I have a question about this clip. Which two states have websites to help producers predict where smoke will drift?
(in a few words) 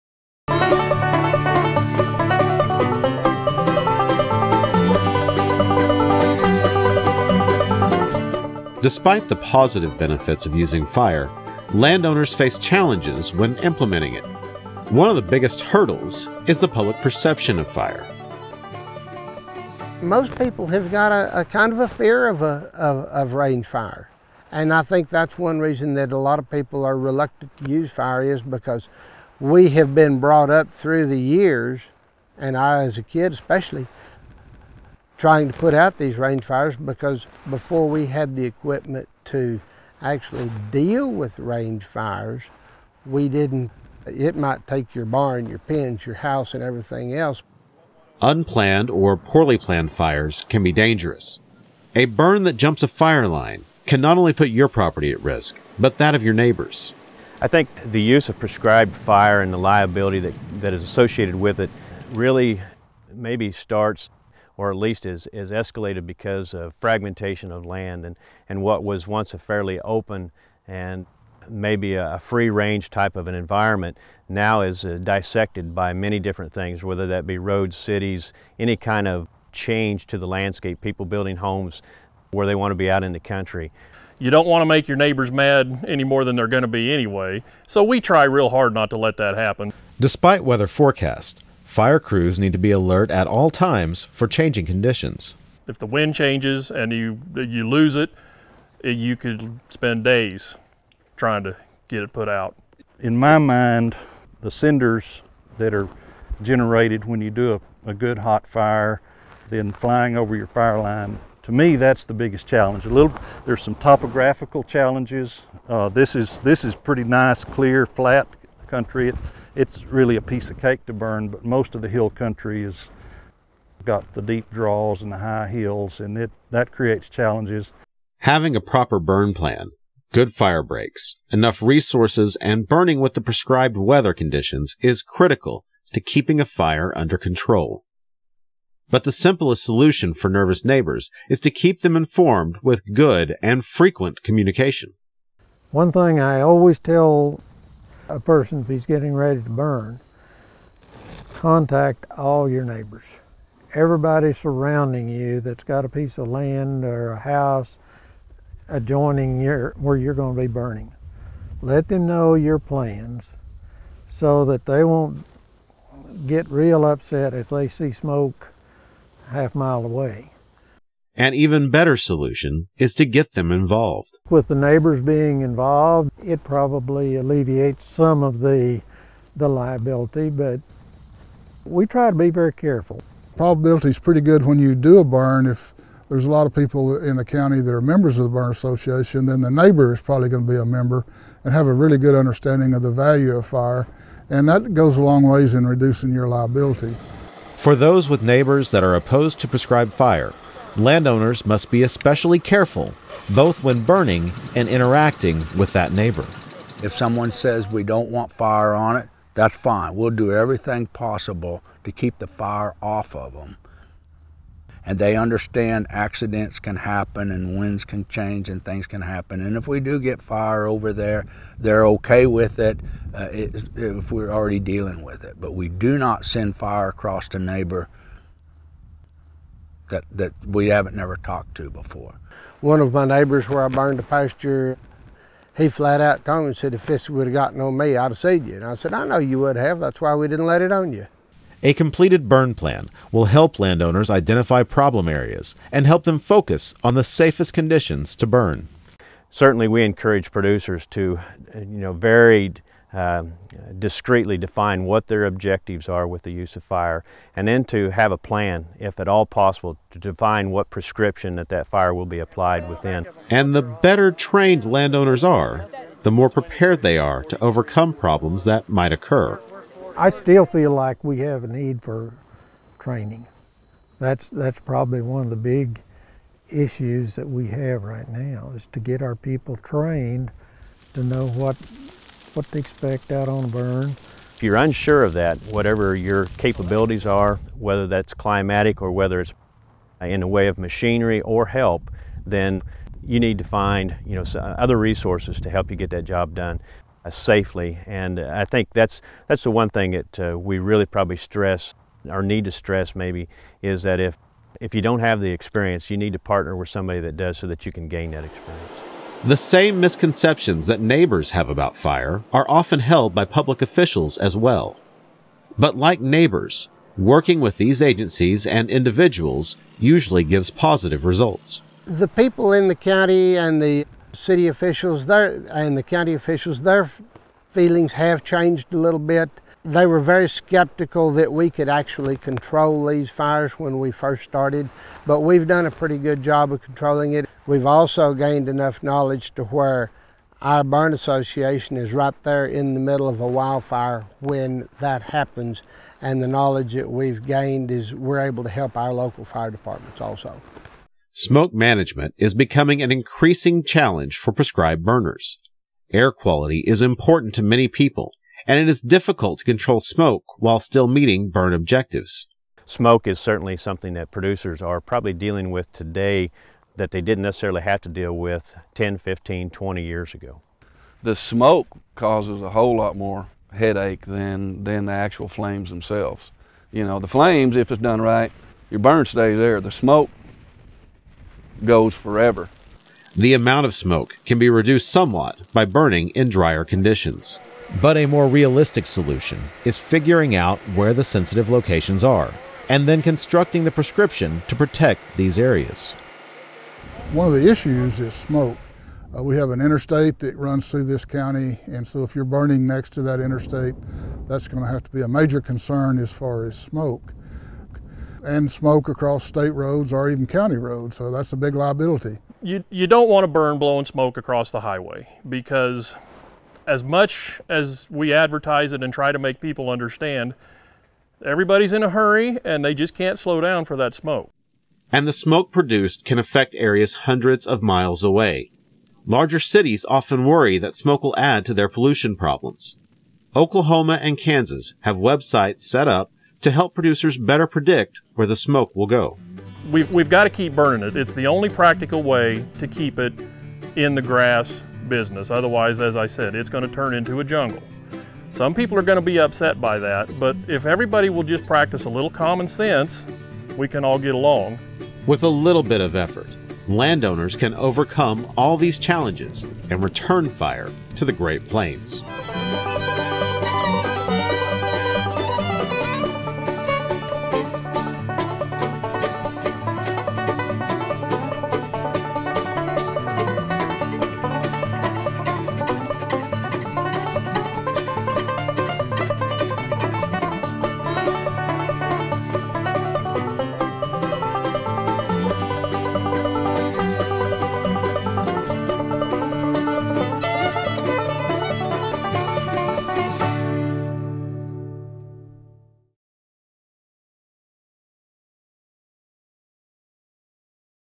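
Oklahoma and Kansas.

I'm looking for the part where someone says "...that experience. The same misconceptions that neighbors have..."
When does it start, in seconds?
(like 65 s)
308 s.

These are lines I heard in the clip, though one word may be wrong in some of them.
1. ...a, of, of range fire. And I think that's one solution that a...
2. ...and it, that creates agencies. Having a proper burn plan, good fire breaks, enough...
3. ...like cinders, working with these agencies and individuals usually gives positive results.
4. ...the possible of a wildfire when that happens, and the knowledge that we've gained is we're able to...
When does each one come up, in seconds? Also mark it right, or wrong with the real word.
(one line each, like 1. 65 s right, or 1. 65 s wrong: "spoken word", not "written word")
1. 22 s wrong: "reason", not "solution"
2. 125 s wrong: "challenges", not "agencies"
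3. 315 s wrong: "neighbors", not "cinders"
4. 342 s wrong: "middle", not "possible".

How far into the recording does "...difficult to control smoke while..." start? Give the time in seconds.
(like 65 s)
358 s.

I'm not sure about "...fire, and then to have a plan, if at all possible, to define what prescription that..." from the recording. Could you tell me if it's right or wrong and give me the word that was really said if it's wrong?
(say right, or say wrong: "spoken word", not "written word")
right.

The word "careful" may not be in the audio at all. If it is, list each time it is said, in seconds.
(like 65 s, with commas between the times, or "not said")
182 s, 202 s.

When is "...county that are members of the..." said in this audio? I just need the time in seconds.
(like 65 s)
187 s.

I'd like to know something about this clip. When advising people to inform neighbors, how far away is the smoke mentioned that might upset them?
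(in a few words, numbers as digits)
half mile.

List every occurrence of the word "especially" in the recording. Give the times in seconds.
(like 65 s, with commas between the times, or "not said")
33 s, 201 s.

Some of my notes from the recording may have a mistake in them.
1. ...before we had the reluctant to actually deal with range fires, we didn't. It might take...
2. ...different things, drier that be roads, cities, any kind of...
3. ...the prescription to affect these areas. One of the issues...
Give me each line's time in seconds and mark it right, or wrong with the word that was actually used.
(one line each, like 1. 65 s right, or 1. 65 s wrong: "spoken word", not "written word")
1. 37 s wrong: "equipment", not "reluctant"
2. 76 s wrong: "whether", not "drier"
3. 393 s wrong: "protect", not "affect".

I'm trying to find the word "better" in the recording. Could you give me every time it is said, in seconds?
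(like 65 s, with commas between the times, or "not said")
171 s, 263 s, 437 s.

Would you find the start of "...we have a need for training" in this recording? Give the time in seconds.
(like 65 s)
271 s.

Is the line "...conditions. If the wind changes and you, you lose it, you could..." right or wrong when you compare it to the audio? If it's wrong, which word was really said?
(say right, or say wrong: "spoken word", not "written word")
right.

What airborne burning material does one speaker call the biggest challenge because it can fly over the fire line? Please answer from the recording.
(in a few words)
cinders.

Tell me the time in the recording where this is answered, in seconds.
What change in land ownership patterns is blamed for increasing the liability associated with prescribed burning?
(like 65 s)
66 s.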